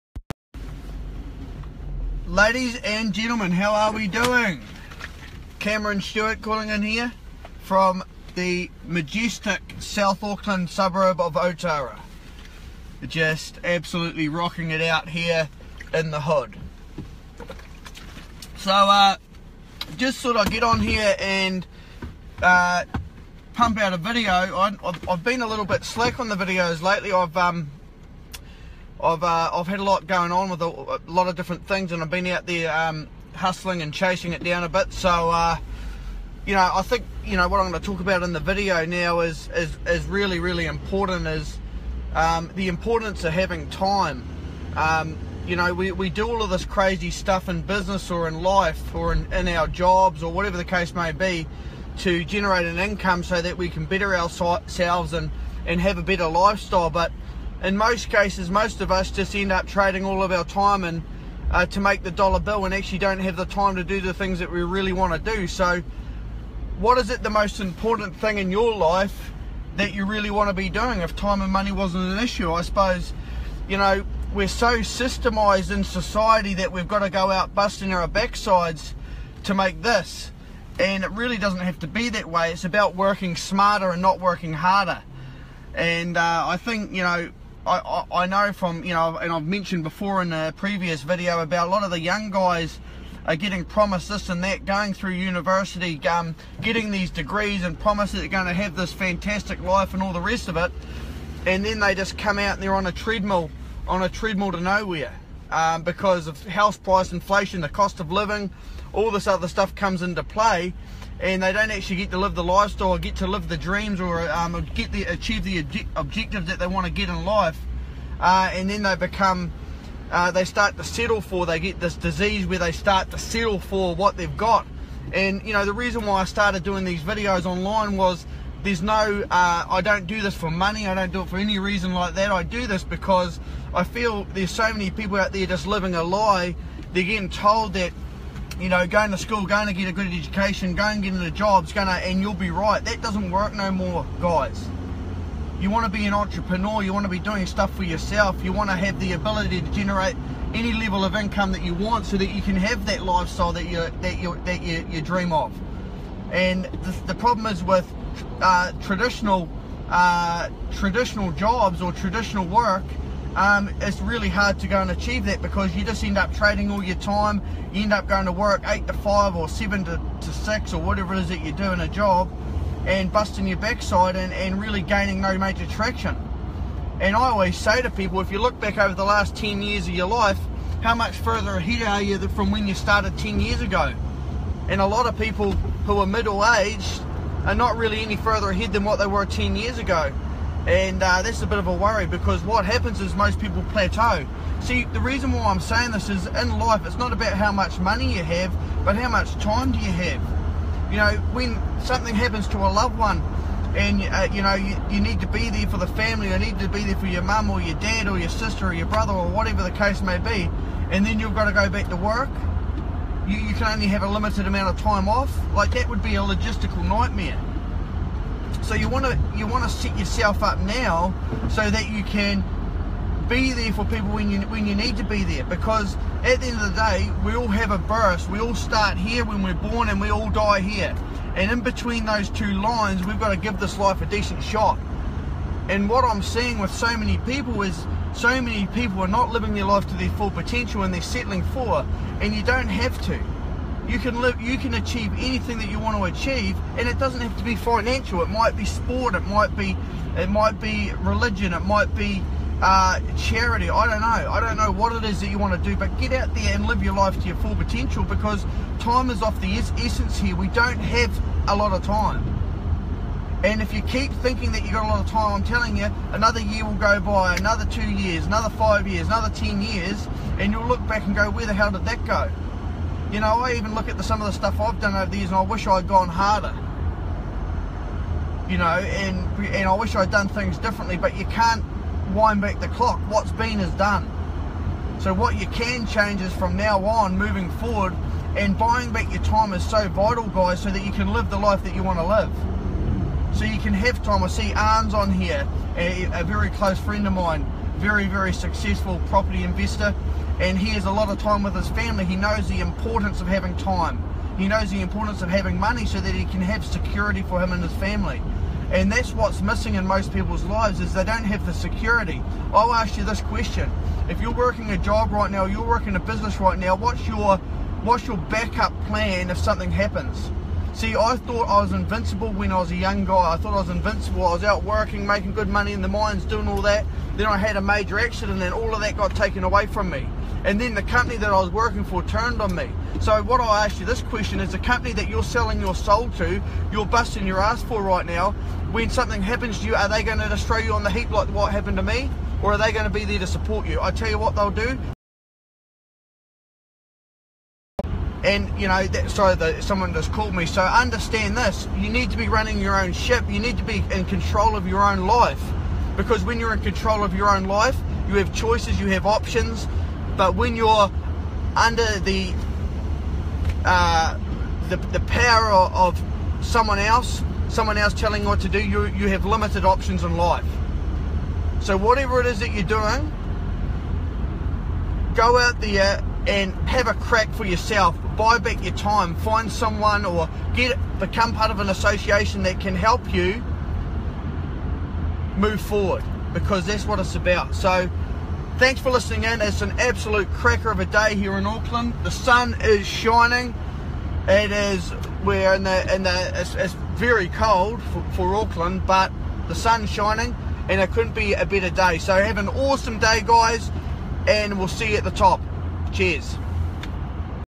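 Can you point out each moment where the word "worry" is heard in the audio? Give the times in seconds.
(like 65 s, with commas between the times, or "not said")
191 s.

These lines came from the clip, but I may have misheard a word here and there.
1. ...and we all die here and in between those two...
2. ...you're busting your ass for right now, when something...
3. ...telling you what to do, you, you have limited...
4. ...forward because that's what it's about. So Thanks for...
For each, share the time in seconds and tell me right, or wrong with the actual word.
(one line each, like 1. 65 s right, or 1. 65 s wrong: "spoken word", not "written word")
1. 229 s right
2. 336 s right
3. 367 s right
4. 385 s right.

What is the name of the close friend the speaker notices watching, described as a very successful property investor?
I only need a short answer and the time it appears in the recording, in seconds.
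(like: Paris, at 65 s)
Arns, at 294 s.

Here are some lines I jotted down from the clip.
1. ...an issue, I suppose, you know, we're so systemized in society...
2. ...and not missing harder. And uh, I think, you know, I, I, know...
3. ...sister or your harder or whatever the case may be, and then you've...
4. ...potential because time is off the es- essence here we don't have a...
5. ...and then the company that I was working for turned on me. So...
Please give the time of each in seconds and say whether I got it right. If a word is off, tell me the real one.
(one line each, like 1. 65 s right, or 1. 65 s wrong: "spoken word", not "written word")
1. 72 s right
2. 83 s wrong: "working", not "missing"
3. 208 s wrong: "brother", not "harder"
4. 257 s right
5. 330 s right.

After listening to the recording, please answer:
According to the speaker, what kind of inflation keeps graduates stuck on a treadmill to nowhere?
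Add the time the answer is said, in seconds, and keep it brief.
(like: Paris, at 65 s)
house price inflation, at 106 s.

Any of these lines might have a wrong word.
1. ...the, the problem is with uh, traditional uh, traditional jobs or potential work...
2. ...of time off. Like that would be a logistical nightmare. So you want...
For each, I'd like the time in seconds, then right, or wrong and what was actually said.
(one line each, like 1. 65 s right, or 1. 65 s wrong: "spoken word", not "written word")
1. 156 s wrong: "traditional", not "potential"
2. 214 s right.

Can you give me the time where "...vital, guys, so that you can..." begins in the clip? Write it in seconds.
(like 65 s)
289 s.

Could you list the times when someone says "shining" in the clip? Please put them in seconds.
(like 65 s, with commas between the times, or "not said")
392 s, 399 s.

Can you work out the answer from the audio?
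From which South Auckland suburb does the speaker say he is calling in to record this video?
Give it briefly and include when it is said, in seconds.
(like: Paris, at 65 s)
Otara, at 11 s.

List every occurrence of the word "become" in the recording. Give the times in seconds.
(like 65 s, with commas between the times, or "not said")
118 s, 380 s.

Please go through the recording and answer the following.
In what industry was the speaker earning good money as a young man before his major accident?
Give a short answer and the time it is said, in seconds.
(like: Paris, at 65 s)
the mines, at 325 s.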